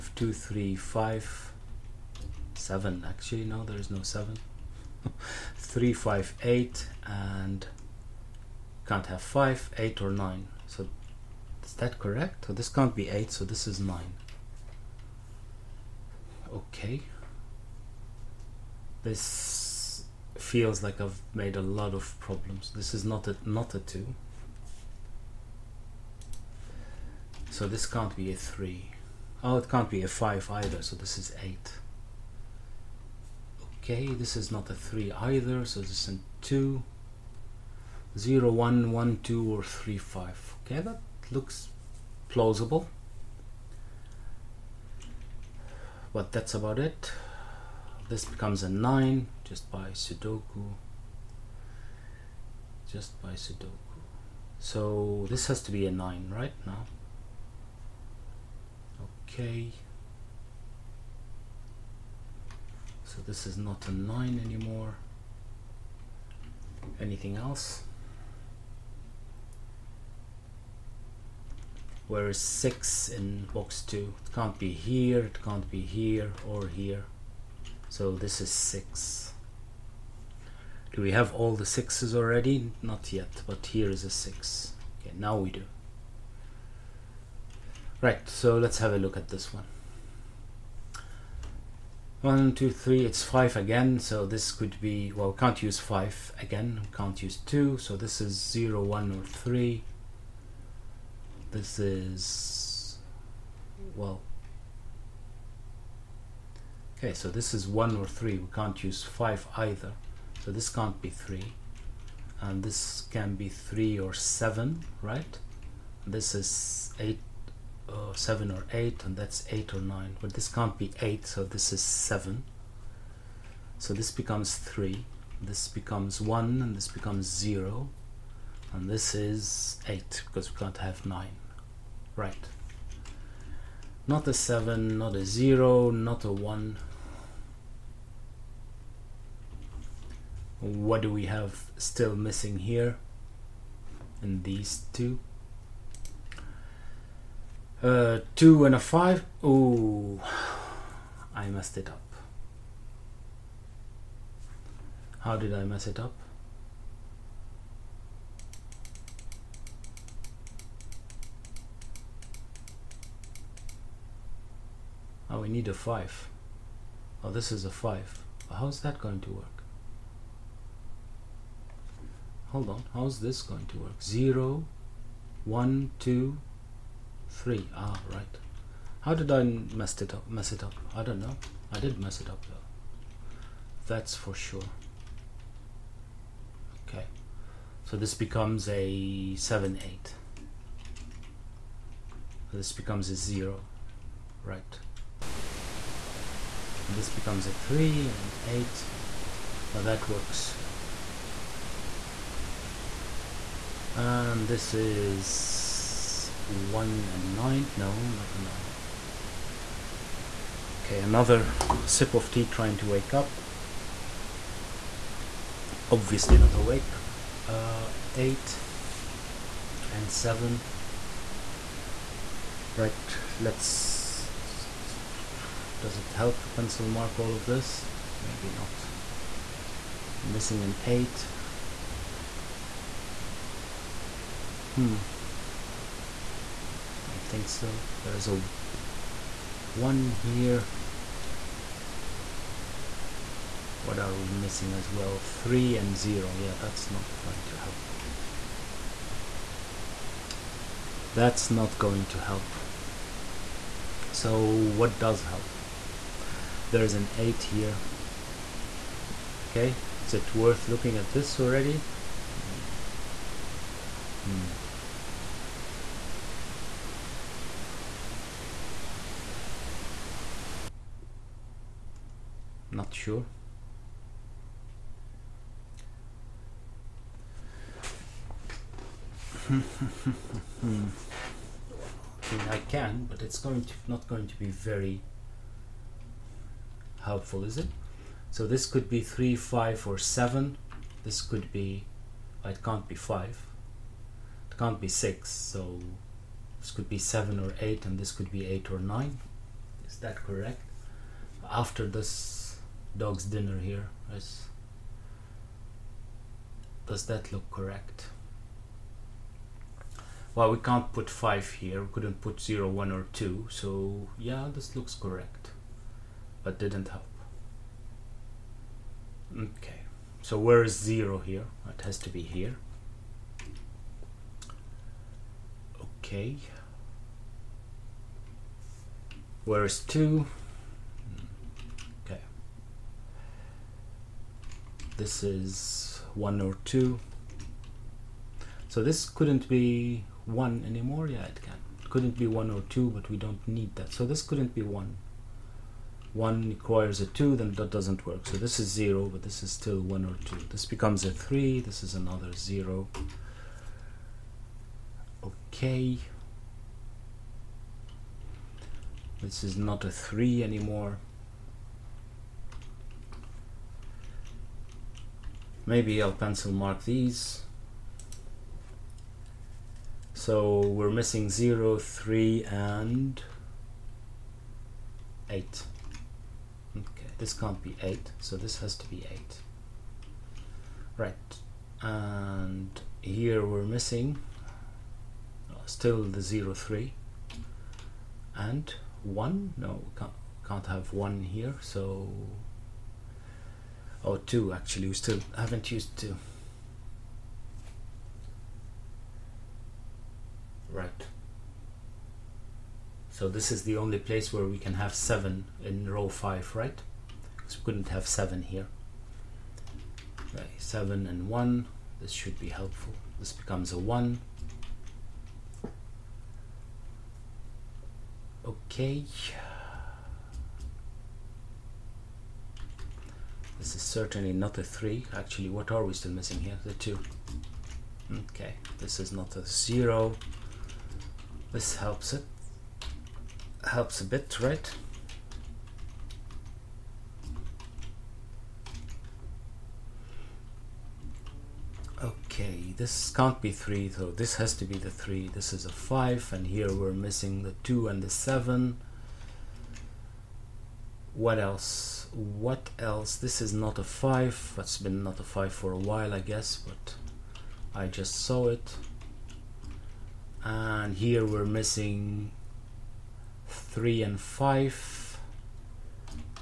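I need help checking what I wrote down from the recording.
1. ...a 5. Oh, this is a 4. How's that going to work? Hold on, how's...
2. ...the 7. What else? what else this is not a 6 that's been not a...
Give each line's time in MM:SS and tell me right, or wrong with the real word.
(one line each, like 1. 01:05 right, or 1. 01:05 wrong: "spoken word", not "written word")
1. 02:45 wrong: "5", not "4"
2. 07:28 wrong: "5", not "6".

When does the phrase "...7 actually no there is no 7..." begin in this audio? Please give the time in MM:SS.
00:02.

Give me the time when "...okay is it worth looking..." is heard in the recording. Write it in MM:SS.
04:19.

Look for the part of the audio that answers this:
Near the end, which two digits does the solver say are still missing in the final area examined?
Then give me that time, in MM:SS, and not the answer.
07:43.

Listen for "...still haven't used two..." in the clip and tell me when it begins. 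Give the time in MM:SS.
06:34.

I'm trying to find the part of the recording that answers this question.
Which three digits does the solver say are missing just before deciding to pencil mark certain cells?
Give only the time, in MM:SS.
06:11.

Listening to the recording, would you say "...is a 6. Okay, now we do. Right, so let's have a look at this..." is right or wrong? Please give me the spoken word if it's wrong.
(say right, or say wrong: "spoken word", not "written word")
right.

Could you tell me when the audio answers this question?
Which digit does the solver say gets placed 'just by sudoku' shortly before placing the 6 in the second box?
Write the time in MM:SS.
00:48.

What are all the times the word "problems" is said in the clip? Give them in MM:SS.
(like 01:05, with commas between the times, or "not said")
00:22.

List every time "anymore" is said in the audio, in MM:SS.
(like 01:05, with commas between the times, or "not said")
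01:04, 05:40, 06:00.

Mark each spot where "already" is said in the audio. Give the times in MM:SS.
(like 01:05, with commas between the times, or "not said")
01:22, 04:21.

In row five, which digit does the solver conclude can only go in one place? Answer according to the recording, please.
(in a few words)
7.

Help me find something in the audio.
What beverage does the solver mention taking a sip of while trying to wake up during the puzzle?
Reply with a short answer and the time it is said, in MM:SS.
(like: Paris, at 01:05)
Tea, at 03:30.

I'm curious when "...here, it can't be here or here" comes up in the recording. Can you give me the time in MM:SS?
01:14.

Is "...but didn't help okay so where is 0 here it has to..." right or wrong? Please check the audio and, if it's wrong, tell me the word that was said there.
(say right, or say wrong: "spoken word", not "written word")
right.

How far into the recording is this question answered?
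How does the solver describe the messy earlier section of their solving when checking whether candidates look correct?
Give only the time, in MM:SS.
05:02.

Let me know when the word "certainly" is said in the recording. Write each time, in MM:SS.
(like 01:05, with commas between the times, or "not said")
07:03.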